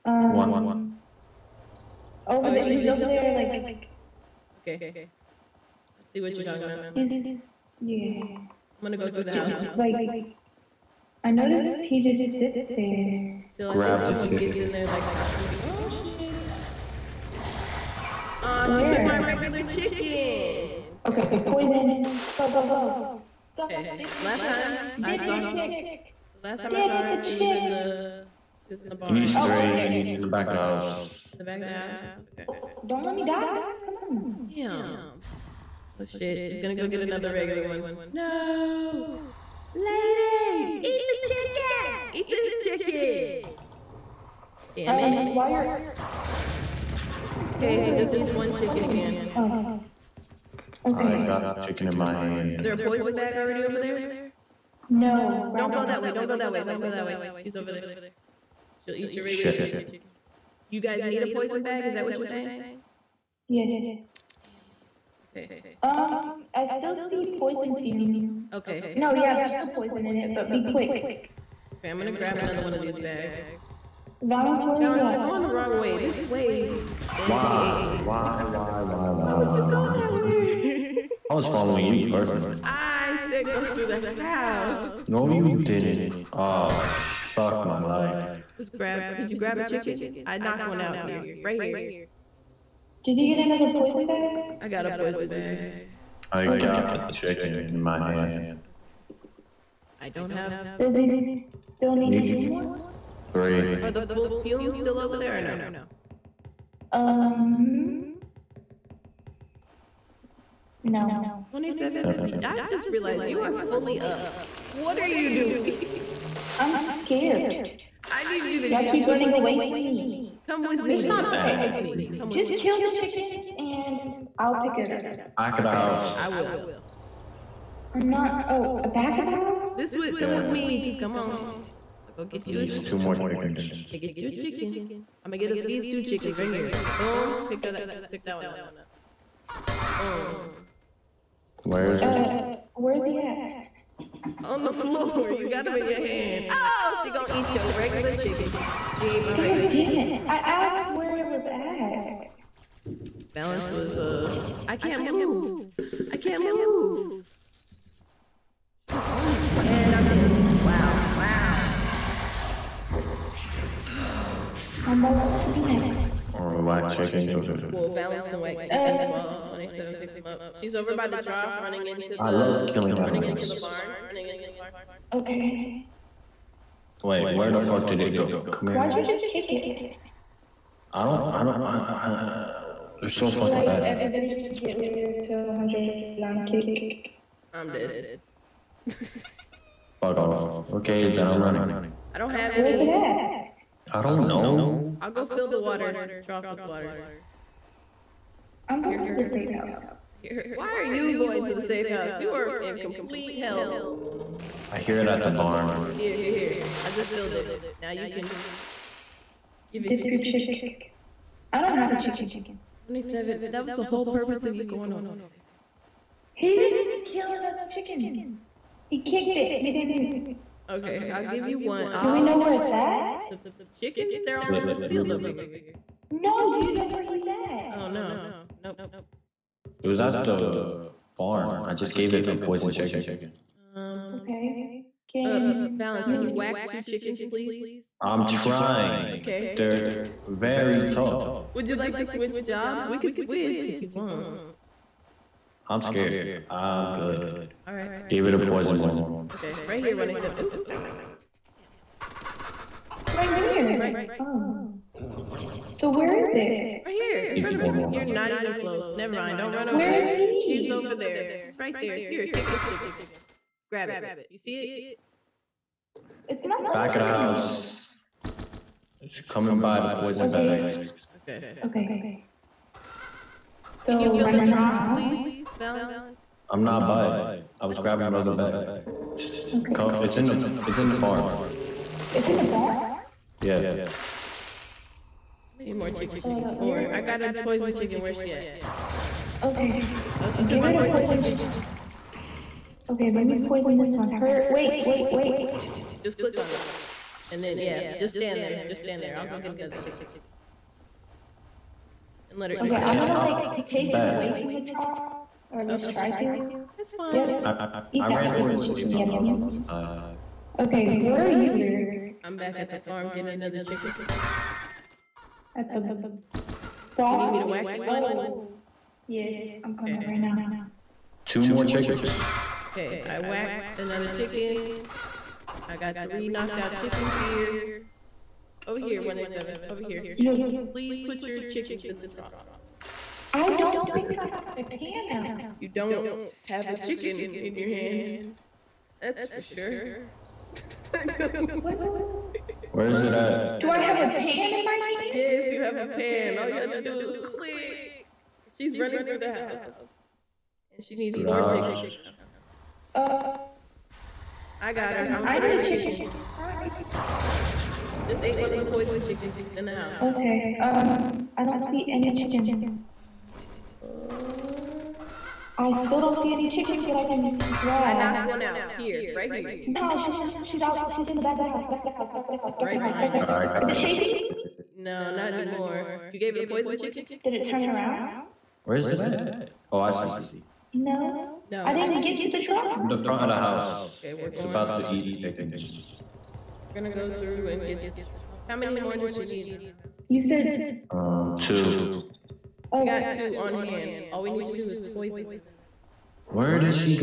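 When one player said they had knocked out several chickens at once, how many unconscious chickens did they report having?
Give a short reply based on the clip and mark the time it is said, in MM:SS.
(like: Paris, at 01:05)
3, at 05:26.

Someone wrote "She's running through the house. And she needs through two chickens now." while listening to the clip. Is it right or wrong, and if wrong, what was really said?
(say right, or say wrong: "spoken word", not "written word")
wrong: "four", not "two".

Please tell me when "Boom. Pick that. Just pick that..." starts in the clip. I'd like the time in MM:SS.
02:16.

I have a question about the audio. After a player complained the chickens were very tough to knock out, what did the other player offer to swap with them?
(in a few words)
jobs.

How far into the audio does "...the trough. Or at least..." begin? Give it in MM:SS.
05:04.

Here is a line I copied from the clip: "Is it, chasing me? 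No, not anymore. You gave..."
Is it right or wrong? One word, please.
right.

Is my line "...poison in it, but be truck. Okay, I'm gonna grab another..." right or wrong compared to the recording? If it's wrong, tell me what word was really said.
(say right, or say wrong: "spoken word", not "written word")
wrong: "quick", not "truck".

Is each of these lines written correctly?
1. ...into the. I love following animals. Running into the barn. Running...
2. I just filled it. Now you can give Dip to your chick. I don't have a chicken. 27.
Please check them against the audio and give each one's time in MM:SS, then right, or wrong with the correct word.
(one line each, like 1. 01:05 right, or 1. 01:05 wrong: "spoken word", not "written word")
1. 02:51 wrong: "killing", not "following"
2. 03:26 right.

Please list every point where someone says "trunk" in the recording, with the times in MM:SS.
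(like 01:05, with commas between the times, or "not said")
05:32.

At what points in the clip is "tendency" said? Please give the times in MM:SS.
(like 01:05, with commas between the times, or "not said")
not said.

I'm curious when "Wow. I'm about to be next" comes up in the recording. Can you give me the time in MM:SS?
02:41.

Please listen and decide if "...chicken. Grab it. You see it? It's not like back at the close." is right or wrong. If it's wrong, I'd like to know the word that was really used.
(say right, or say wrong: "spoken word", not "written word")
wrong: "house", not "close".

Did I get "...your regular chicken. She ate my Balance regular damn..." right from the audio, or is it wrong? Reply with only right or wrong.
wrong.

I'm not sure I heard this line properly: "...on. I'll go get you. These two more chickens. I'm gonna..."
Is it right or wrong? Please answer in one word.
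right.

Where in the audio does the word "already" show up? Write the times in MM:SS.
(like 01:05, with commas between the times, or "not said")
00:53.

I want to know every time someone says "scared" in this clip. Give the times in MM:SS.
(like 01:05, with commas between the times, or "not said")
01:56, 04:05.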